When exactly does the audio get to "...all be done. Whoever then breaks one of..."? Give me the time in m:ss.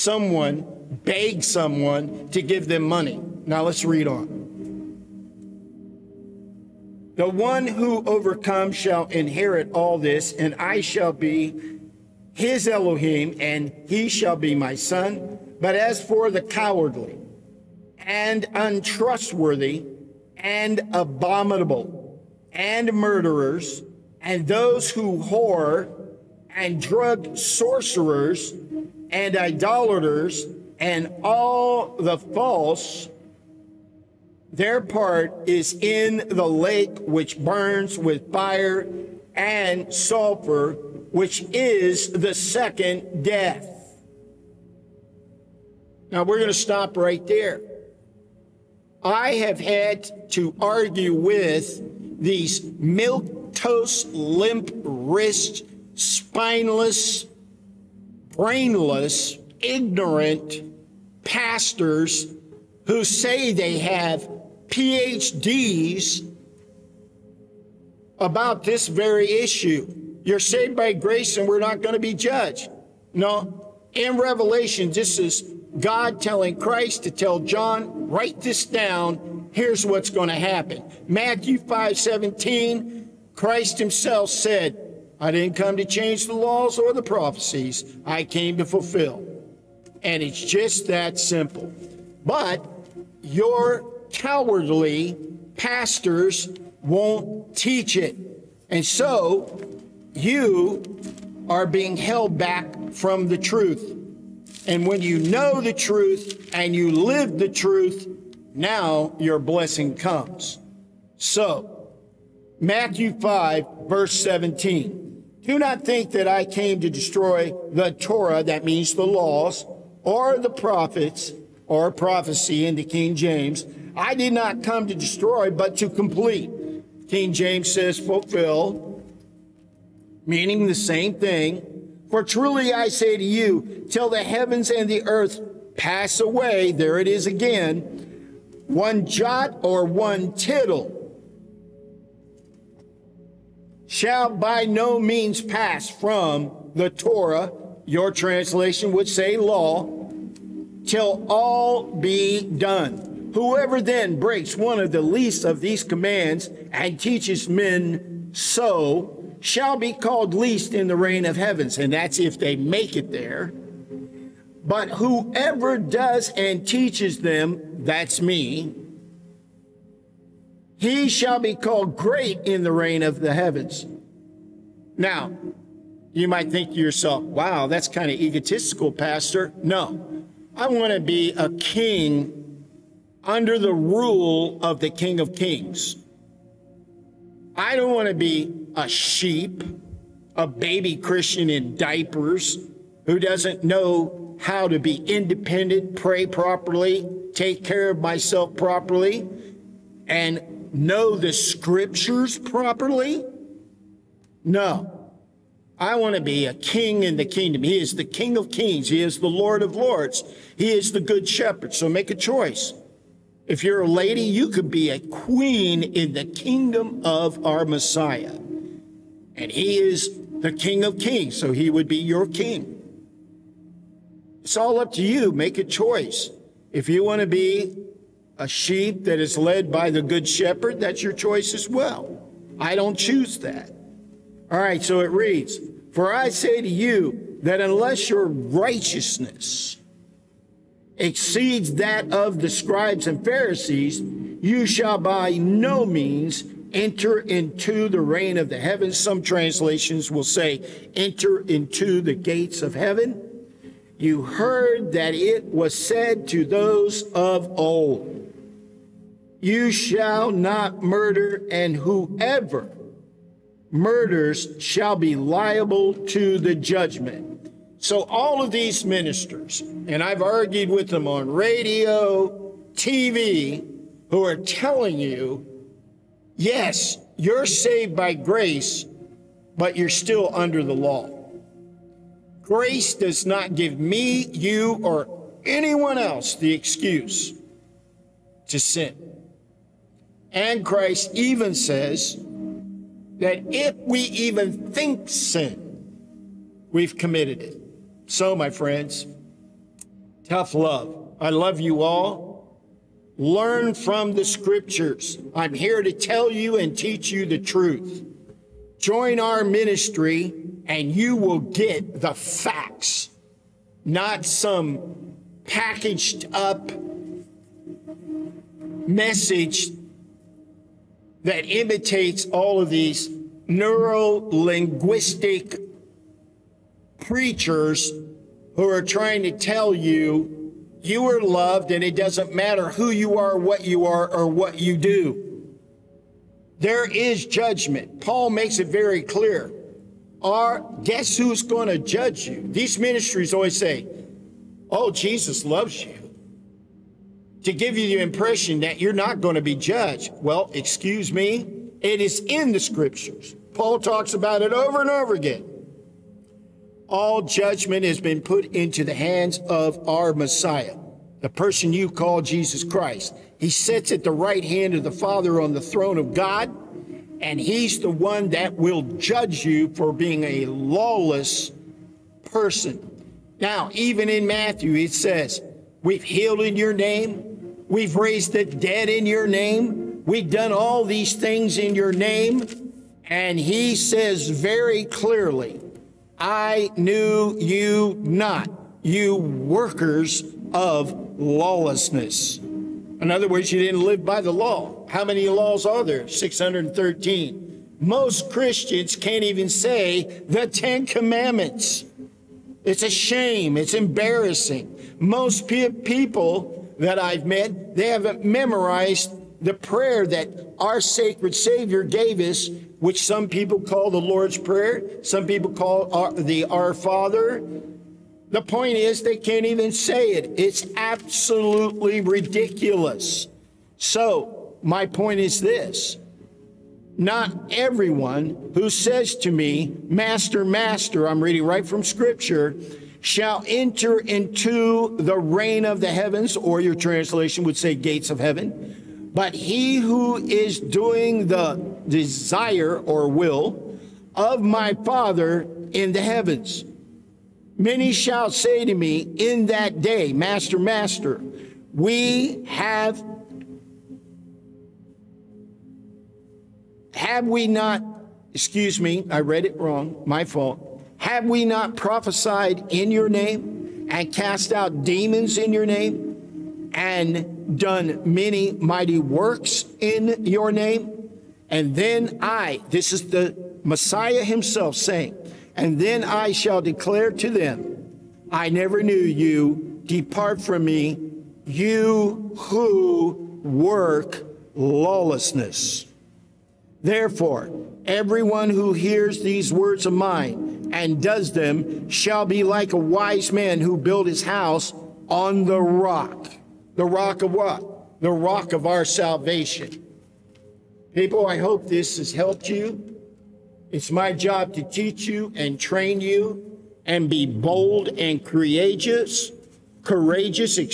2:31.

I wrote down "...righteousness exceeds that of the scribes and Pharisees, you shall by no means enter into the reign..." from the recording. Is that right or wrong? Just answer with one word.
right.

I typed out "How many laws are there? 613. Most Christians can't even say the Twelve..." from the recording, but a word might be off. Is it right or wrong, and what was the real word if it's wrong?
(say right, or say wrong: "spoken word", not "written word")
wrong: "Ten", not "Twelve".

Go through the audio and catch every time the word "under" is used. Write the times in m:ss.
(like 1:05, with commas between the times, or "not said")
3:03, 4:40.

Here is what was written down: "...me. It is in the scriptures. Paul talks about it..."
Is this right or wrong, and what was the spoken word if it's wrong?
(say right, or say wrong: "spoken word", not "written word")
right.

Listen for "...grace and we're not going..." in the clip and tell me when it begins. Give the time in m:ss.
1:10.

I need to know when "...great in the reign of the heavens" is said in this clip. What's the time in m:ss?
2:51.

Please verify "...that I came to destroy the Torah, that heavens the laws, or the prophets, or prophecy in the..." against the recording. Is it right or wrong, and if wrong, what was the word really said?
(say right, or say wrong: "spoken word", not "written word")
wrong: "means", not "heavens".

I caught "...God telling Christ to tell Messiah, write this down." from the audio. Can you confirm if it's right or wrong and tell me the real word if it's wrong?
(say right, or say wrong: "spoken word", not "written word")
wrong: "John", not "Messiah".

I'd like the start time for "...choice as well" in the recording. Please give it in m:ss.
3:51.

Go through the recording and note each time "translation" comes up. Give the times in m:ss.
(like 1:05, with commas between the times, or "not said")
2:28, 4:09, 7:16.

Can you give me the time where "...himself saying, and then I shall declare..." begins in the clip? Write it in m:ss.
7:54.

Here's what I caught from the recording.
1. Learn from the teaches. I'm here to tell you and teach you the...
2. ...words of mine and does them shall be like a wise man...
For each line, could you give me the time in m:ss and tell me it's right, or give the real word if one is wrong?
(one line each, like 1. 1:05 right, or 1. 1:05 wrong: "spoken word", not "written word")
1. 5:03 wrong: "scriptures", not "teaches"
2. 8:09 right.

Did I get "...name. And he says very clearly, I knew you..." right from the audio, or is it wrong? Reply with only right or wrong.
right.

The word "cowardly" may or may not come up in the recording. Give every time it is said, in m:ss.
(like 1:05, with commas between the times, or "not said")
0:16, 1:34.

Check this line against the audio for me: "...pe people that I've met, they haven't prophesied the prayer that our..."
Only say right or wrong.
wrong.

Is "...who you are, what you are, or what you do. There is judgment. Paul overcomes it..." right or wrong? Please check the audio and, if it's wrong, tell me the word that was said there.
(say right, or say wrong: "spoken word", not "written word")
wrong: "makes", not "overcomes".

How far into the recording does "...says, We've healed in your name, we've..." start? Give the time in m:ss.
6:14.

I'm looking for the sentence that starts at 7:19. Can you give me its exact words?
But he who is doing the desire or will of my Father in the heavens.